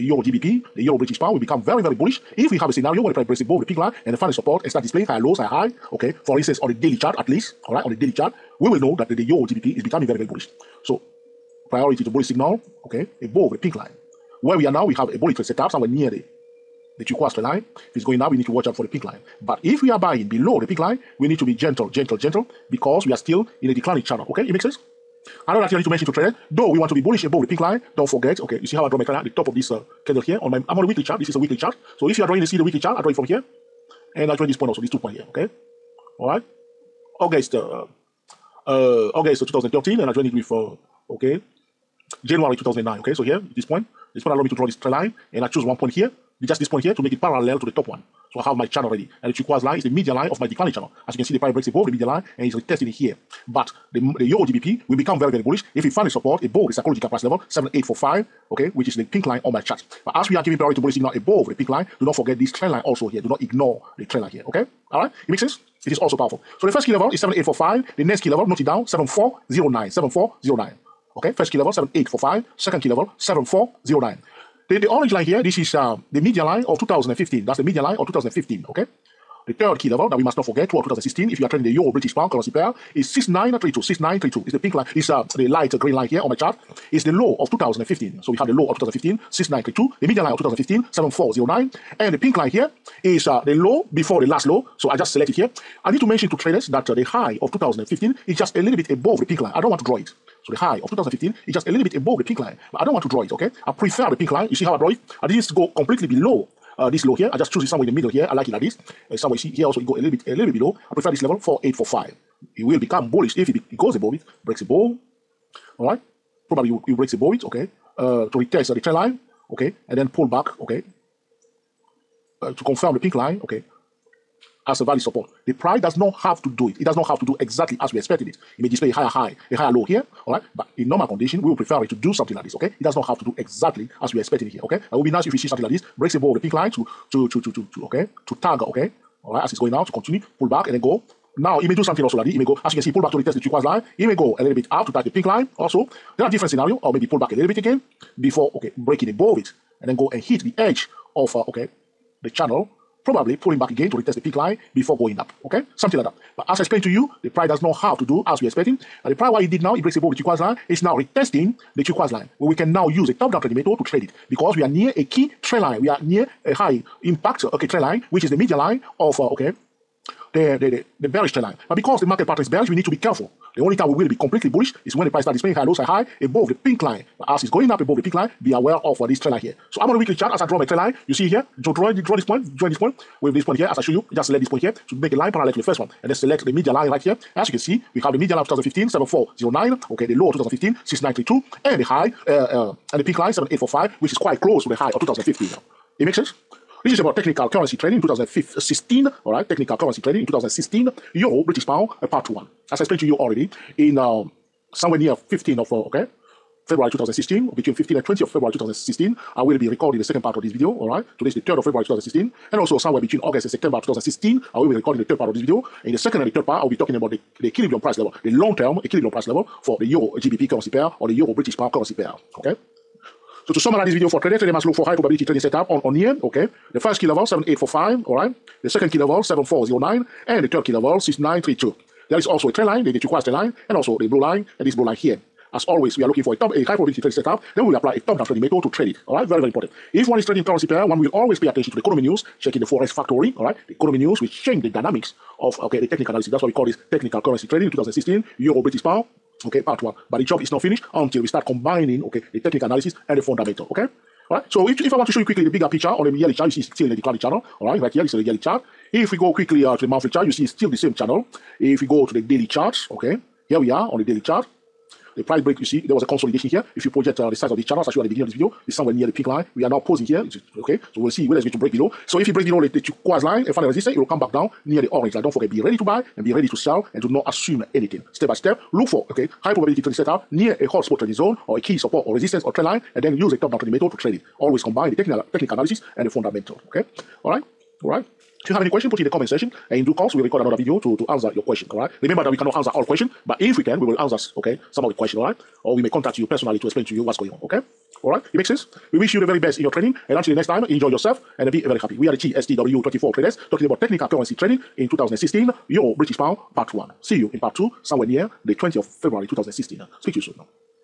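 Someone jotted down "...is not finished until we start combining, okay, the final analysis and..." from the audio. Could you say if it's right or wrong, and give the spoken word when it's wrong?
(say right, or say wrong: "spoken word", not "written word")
wrong: "technical", not "final".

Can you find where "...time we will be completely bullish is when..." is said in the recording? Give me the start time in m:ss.
2:53.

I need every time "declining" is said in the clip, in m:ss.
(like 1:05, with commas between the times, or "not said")
0:23, 0:50, 4:16.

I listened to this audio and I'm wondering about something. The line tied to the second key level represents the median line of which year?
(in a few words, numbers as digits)
2015.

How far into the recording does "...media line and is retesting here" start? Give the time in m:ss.
0:51.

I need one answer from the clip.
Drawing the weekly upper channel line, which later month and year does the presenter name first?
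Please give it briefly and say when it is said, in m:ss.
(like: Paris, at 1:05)
August 2013, at 0:39.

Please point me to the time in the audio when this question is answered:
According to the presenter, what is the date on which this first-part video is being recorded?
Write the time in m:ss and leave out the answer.
3:31.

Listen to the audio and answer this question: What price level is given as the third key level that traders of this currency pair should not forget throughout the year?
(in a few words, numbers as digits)
6932.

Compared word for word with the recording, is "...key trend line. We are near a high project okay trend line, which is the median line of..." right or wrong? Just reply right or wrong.
wrong.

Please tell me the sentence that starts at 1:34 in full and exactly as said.
So I just select it here.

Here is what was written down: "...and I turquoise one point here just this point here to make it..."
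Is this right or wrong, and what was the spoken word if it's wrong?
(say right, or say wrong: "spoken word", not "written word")
wrong: "choose", not "turquoise".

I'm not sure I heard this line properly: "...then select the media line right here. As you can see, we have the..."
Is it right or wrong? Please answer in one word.
right.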